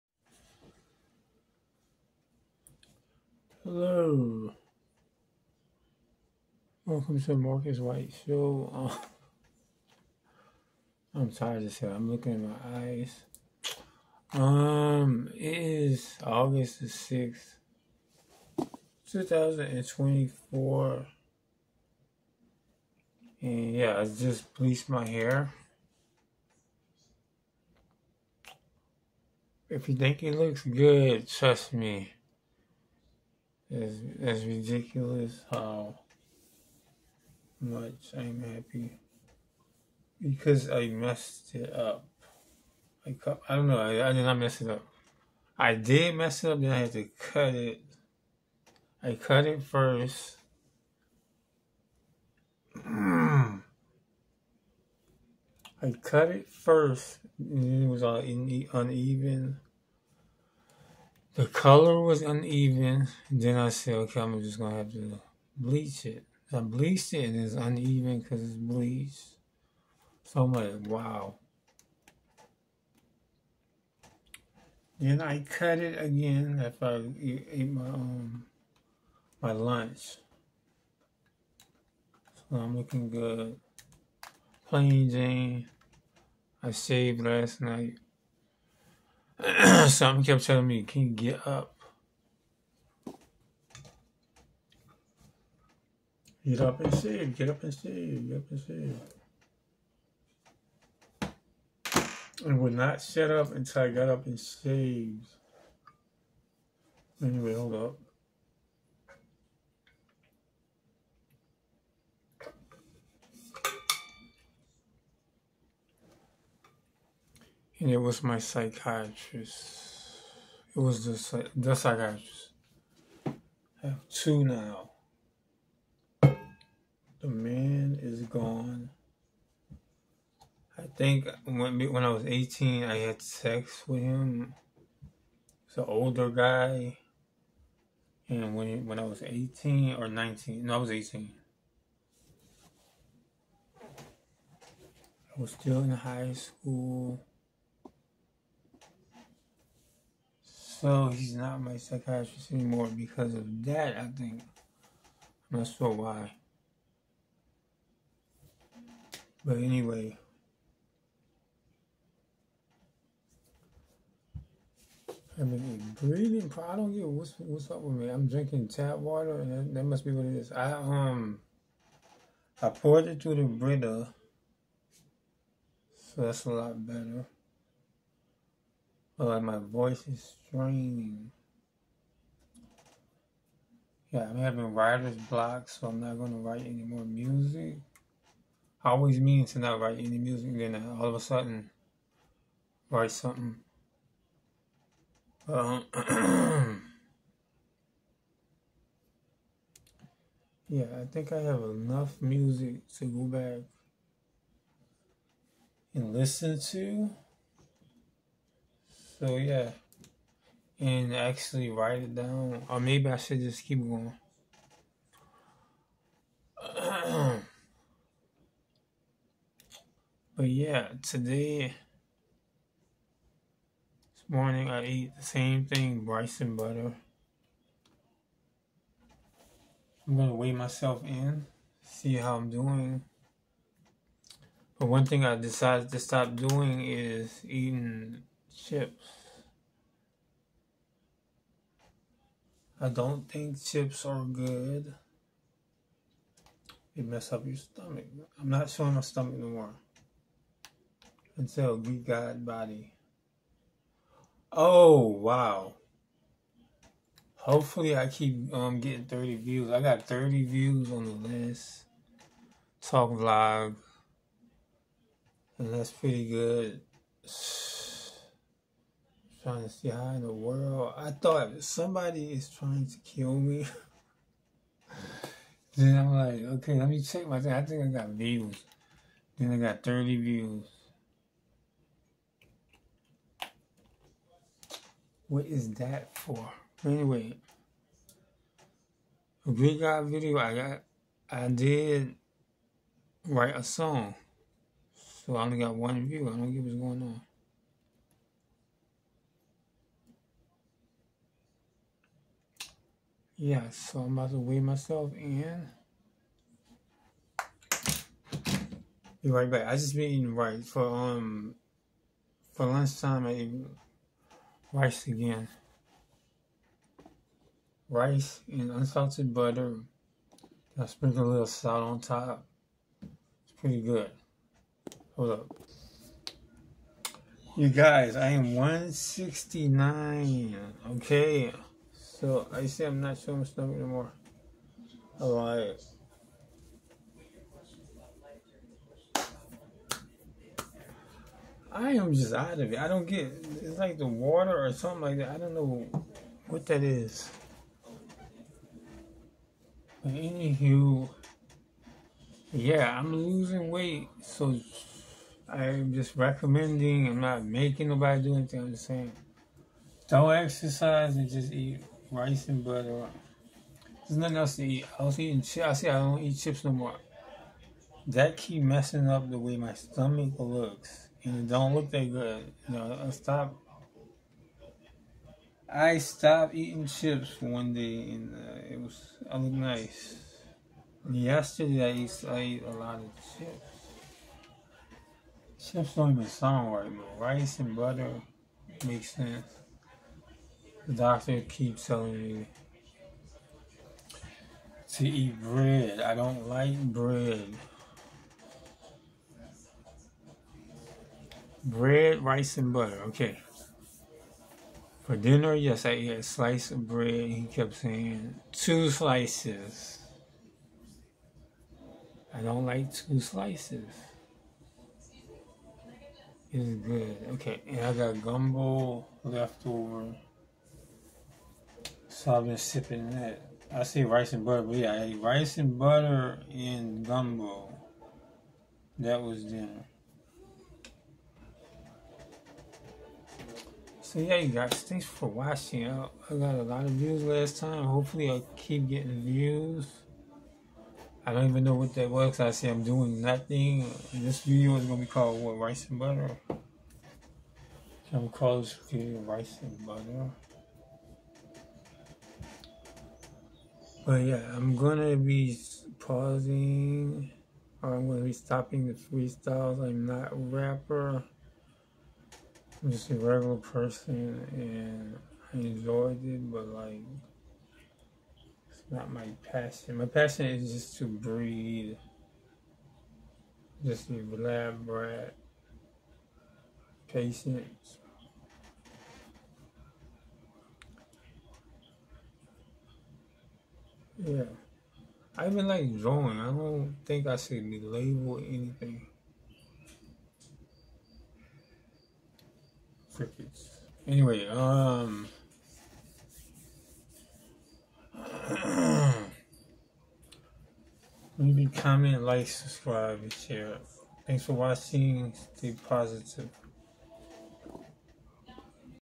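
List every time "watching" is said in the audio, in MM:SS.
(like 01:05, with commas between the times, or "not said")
07:15, 08:24.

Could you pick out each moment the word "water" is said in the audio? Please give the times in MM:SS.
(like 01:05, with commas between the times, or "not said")
02:48, 05:44.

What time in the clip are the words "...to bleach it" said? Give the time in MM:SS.
01:04.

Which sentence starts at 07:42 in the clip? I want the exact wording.
I'm just a regular person, and I enjoyed it, but like, it's not my passion.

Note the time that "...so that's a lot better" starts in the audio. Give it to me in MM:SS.
02:55.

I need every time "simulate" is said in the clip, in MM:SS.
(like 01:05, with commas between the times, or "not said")
not said.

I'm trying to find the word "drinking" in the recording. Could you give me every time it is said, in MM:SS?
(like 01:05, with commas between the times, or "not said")
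02:48.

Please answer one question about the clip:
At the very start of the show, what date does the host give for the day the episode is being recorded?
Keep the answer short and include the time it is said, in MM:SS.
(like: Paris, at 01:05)
August 6, 2024, at 00:16.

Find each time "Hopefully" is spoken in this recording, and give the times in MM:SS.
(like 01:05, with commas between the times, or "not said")
04:17, 07:17.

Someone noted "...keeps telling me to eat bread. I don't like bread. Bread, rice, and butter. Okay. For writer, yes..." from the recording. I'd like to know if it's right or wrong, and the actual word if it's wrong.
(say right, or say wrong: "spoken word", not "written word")
wrong: "dinner", not "writer".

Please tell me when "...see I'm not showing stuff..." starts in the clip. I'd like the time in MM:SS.
05:32.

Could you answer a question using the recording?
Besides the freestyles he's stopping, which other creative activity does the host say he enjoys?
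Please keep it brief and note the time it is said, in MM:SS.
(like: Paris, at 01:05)
Drawing, at 08:05.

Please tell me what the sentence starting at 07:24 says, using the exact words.
This video is going to be called, what, rice and butter?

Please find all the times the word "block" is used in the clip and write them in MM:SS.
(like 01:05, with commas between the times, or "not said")
03:05.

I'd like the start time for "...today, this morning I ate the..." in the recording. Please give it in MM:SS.
03:41.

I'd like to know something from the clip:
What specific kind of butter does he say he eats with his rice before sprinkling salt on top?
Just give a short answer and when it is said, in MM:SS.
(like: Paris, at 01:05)
Unsalted butter, at 05:18.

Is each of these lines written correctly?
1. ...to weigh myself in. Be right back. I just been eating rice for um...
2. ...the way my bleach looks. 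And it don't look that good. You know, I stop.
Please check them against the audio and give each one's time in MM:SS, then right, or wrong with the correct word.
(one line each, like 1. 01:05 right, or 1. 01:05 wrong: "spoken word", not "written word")
1. 05:04 right
2. 06:09 wrong: "stomach", not "bleach".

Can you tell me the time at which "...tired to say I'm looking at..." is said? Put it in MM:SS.
00:11.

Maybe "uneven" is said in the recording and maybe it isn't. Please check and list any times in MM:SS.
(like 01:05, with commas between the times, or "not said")
00:58, 01:02, 01:07.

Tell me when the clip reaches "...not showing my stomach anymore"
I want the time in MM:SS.
04:08.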